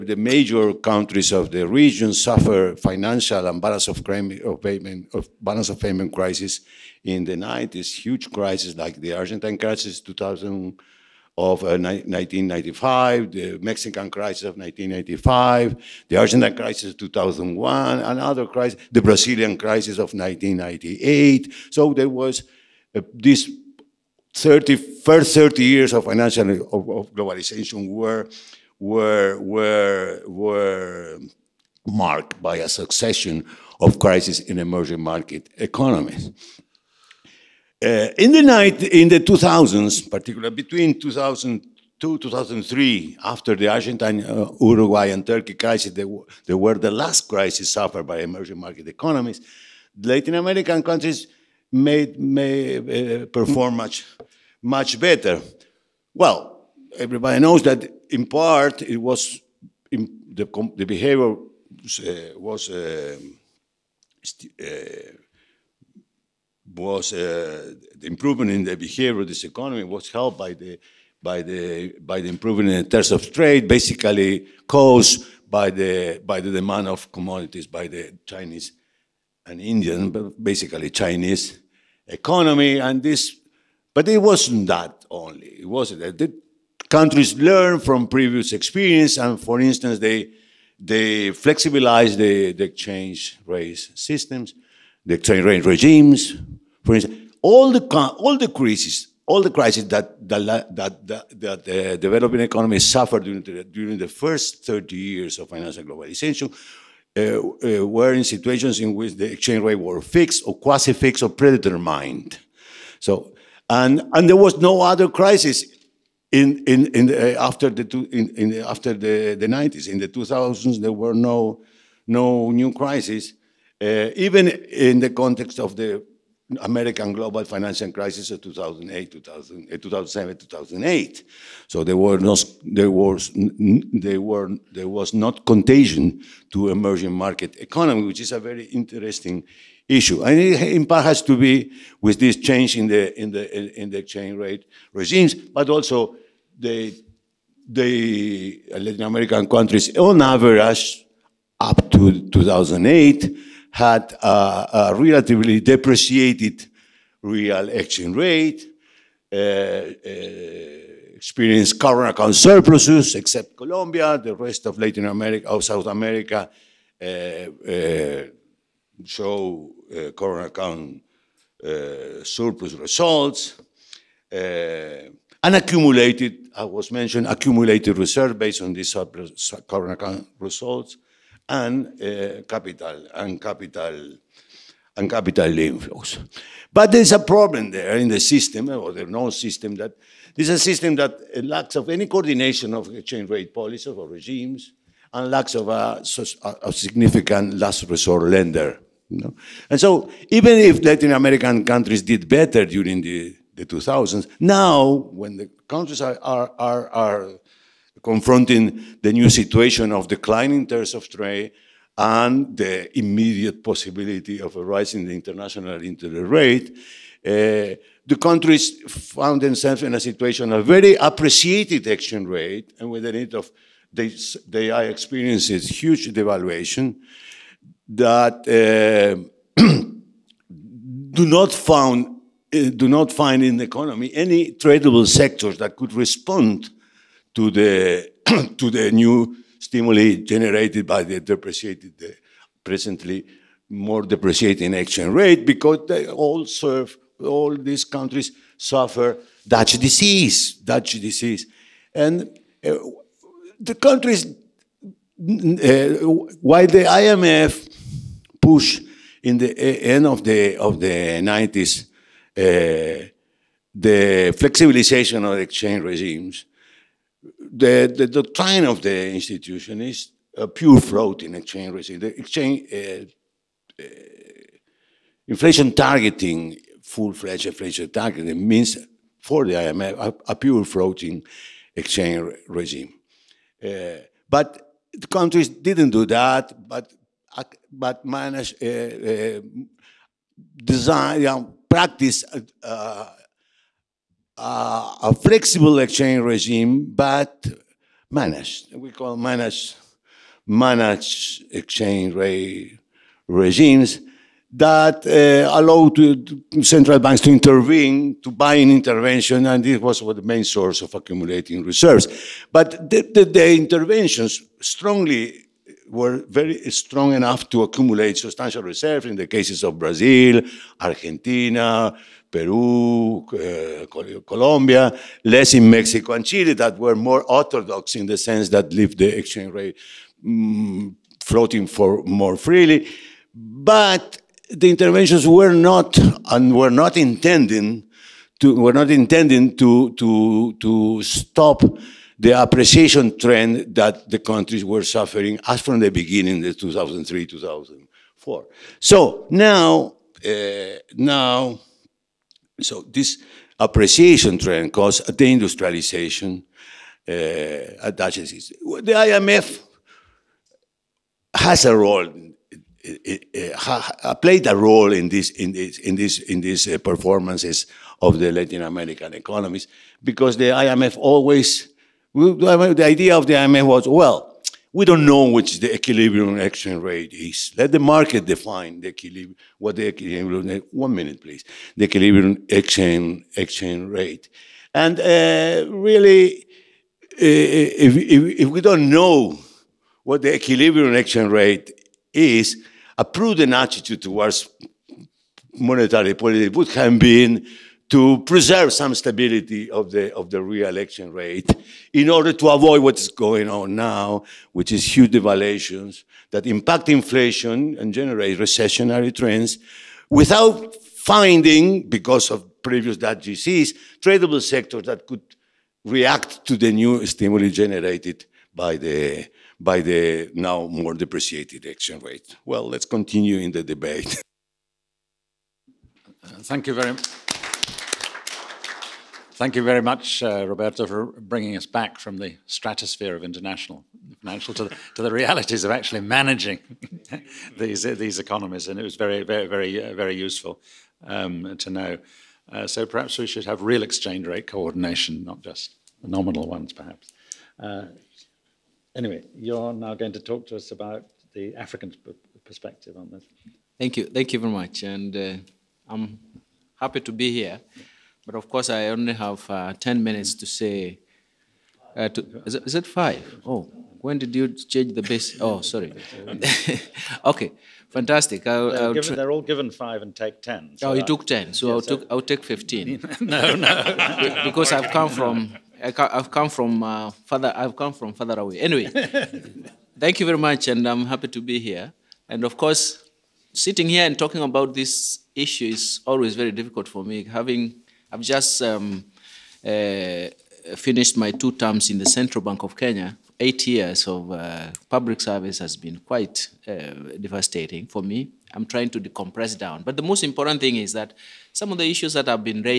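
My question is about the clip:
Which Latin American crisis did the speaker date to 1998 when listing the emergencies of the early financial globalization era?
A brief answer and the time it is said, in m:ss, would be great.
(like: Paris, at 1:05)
Brazilian crisis, at 0:18.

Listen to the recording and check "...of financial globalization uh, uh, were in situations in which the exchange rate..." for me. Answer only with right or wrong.
right.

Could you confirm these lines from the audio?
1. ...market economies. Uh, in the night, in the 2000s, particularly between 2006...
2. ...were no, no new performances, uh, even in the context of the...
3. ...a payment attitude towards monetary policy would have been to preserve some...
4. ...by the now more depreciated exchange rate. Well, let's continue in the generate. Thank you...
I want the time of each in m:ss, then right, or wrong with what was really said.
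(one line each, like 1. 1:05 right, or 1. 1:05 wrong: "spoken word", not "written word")
1. 0:35 wrong: "2002", not "2006"
2. 2:00 wrong: "crises", not "performances"
3. 6:32 wrong: "prudent", not "payment"
4. 6:59 wrong: "debate", not "generate".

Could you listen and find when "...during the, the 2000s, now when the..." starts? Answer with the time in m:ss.
3:22.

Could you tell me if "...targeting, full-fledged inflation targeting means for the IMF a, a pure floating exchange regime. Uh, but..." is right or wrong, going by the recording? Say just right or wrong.
right.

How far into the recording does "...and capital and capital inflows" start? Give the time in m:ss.
3:03.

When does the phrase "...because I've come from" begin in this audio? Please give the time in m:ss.
7:54.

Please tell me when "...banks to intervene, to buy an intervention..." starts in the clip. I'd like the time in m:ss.
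5:06.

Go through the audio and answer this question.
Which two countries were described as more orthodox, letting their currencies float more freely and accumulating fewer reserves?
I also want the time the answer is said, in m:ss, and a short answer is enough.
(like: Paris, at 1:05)
Mexico and Chile, at 5:25.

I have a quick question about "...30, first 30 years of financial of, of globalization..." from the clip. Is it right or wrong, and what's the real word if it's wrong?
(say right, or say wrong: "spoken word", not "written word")
right.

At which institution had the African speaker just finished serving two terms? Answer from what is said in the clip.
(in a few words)
Central Bank of Kenya.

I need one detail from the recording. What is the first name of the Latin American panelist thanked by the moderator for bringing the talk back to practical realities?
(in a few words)
Roberto.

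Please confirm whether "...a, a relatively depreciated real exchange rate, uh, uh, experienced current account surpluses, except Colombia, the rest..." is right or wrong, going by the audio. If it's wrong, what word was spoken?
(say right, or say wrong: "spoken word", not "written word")
right.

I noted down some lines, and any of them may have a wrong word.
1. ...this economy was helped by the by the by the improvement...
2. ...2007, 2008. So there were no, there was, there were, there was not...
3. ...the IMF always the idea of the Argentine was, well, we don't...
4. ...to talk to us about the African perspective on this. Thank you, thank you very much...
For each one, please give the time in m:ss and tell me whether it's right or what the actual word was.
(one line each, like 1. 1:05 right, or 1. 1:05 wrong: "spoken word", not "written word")
1. 1:09 right
2. 2:09 right
3. 6:10 wrong: "IMF", not "Argentine"
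4. 7:30 right.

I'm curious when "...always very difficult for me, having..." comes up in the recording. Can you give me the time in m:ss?
8:06.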